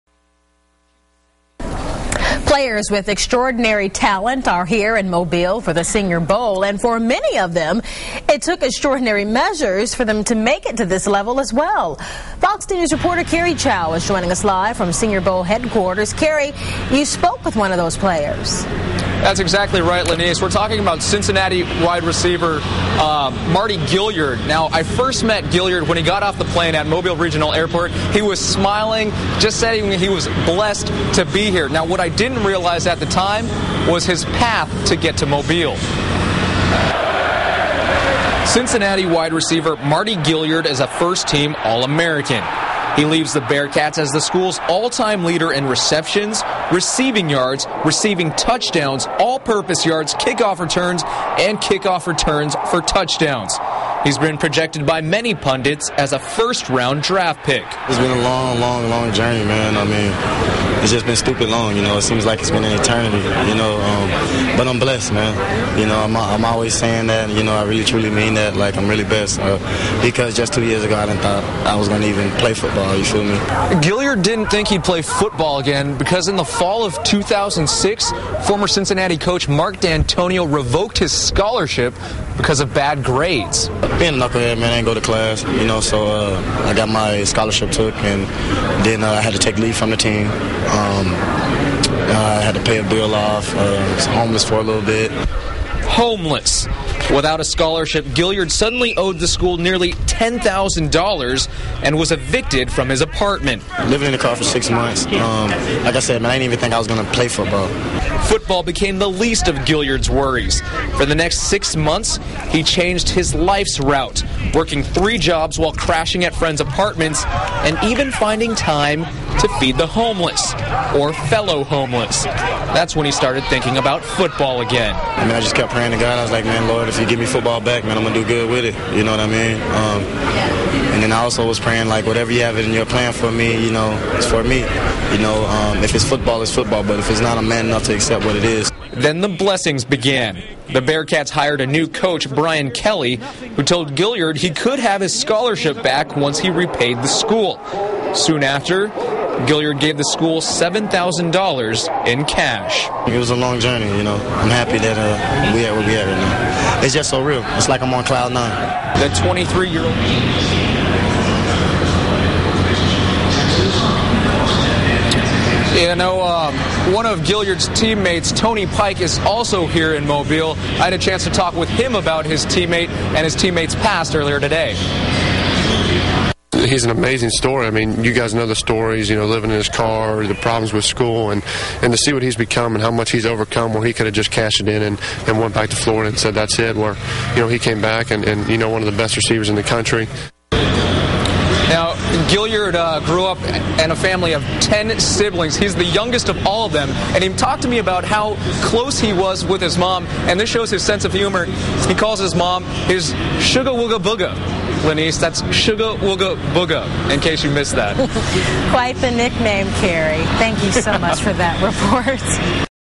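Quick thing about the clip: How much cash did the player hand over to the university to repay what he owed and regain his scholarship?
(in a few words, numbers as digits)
$7,000.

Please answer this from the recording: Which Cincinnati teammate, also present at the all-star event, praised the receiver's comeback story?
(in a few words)
Tony Pike.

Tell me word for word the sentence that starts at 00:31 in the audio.
Now, what I didn't realize at the time was his path to get to Mobile.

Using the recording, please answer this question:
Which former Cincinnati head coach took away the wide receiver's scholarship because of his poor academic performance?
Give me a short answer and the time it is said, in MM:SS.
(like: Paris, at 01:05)
Mark Dantonio, at 01:19.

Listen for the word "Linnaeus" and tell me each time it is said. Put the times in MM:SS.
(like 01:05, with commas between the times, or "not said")
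00:20.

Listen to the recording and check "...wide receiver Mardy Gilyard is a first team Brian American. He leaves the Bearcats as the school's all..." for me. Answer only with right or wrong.
wrong.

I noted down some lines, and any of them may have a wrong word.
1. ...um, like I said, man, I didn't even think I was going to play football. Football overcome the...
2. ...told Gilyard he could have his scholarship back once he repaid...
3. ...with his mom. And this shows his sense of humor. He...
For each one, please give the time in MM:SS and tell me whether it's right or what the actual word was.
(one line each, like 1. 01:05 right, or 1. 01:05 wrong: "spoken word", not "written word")
1. 01:45 wrong: "became", not "overcome"
2. 02:23 right
3. 03:19 right.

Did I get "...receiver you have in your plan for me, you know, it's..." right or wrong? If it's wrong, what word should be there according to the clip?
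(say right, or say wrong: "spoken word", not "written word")
wrong: "whatever", not "receiver".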